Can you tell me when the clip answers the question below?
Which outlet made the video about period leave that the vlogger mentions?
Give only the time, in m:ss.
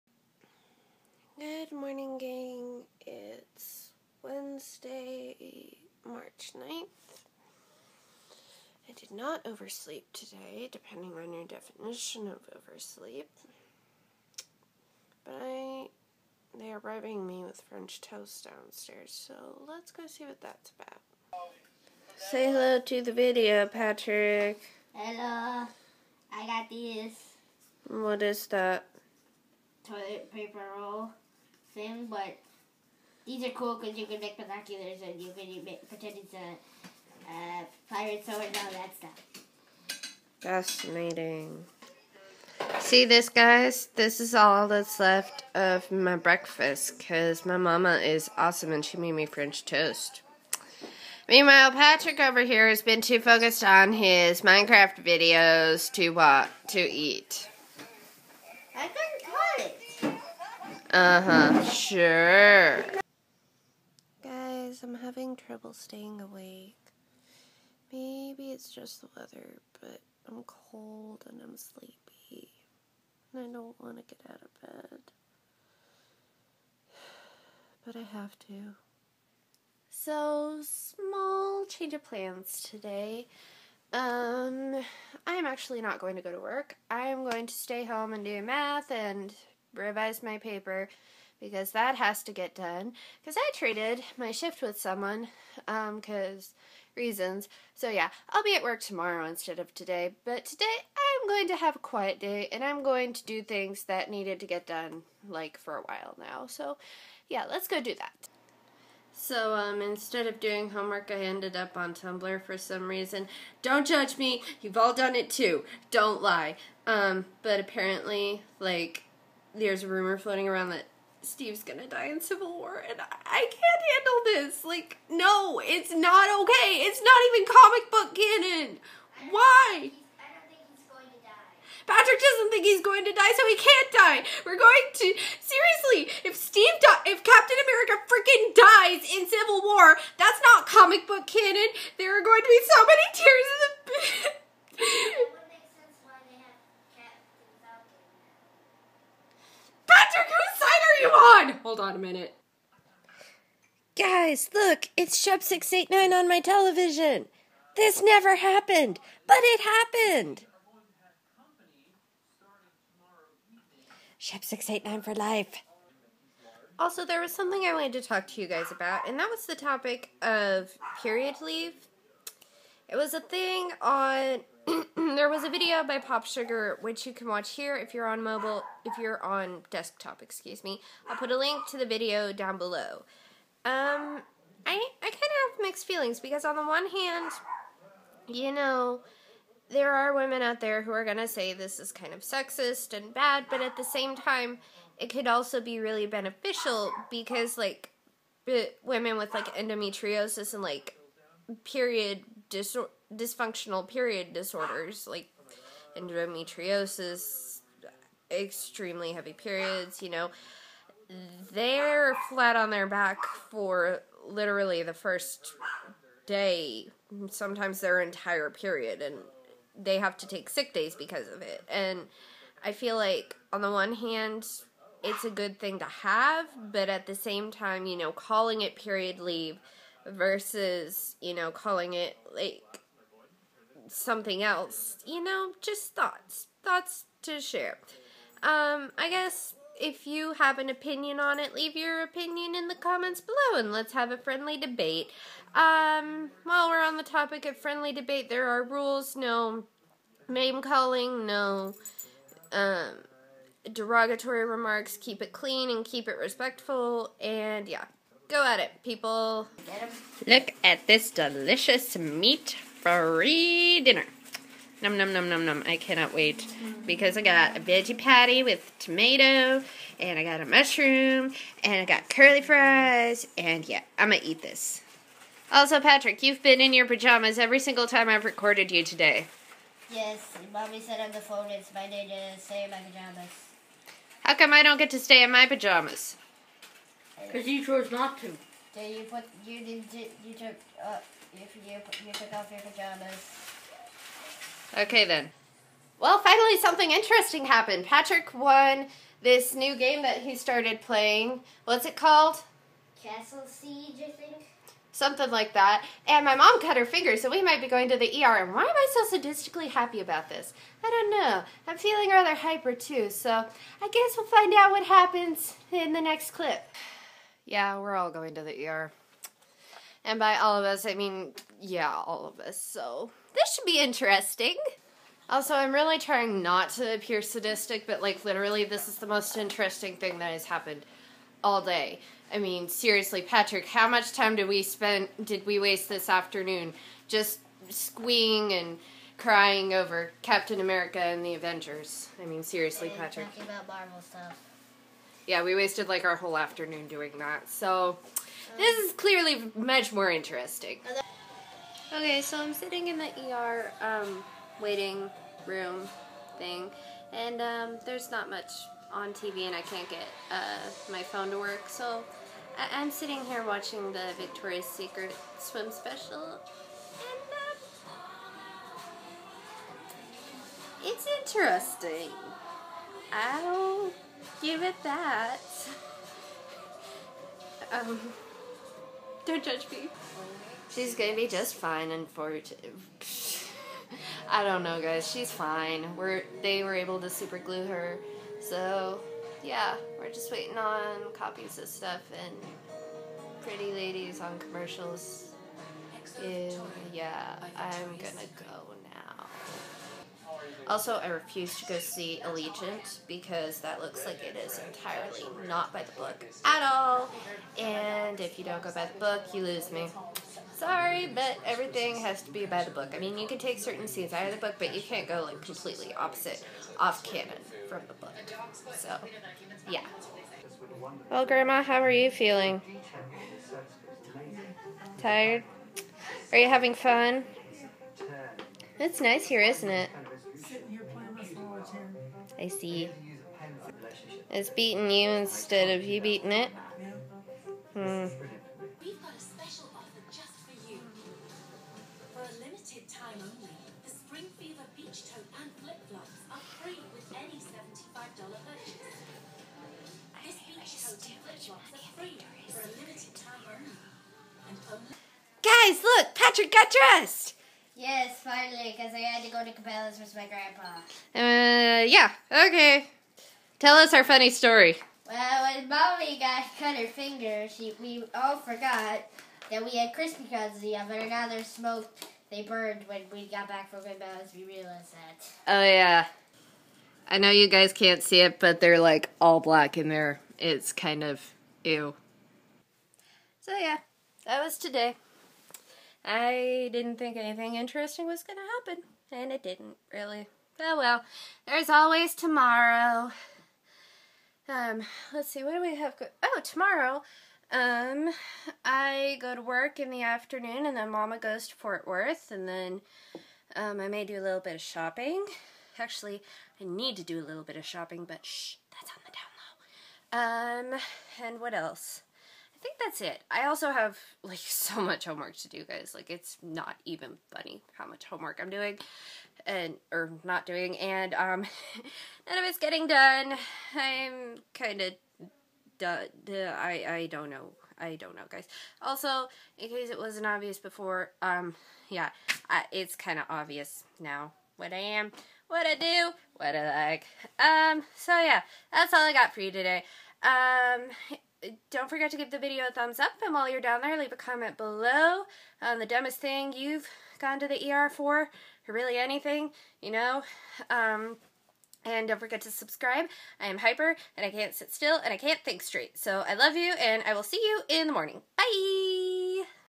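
2:55.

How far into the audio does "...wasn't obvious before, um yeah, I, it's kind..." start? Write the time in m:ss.
8:49.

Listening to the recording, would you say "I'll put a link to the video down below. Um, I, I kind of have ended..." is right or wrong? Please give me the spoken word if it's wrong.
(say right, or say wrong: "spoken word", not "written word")
wrong: "mixed", not "ended".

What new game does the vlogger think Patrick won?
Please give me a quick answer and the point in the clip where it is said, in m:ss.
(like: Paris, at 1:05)
Castle Siege, at 5:03.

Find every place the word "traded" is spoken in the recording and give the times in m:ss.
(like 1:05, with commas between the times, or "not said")
1:33.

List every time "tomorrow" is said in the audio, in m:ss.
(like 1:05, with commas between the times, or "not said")
1:38, 8:12, 8:16.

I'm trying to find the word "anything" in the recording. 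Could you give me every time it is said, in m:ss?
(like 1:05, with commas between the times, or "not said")
8:07, 9:08.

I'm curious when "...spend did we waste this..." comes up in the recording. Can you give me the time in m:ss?
5:34.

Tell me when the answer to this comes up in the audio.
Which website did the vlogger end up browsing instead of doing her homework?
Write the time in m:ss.
1:51.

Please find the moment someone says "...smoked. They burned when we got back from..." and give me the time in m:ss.
7:51.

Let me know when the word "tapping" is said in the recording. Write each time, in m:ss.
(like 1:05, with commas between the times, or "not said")
not said.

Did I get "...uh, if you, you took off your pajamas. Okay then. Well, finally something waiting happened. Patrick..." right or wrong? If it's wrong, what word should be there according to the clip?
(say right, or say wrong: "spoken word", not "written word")
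wrong: "interesting", not "waiting".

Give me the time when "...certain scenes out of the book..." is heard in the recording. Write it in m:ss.
6:53.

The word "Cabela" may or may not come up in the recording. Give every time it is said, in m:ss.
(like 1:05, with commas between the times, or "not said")
7:39, 7:53.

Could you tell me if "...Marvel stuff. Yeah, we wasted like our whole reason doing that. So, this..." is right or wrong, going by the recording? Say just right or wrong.
wrong.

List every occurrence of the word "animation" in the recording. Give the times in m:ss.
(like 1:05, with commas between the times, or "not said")
not said.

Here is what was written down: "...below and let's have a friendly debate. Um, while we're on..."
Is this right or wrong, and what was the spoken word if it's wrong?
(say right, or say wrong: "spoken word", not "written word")
right.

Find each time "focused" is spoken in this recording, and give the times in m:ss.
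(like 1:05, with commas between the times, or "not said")
0:53.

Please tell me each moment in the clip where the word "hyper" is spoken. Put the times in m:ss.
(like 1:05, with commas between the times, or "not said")
5:12, 9:13.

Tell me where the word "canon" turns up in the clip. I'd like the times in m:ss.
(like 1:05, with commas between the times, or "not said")
2:08, 2:21, 6:57.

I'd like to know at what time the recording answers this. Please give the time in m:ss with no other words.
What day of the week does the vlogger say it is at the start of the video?
0:04.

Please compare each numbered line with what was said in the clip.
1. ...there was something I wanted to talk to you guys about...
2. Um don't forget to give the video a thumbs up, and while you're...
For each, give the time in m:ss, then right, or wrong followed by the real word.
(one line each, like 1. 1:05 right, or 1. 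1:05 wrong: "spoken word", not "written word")
1. 2:47 right
2. 9:00 right.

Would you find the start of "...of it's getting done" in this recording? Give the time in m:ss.
8:42.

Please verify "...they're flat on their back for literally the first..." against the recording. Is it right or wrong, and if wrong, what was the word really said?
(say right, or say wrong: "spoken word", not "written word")
right.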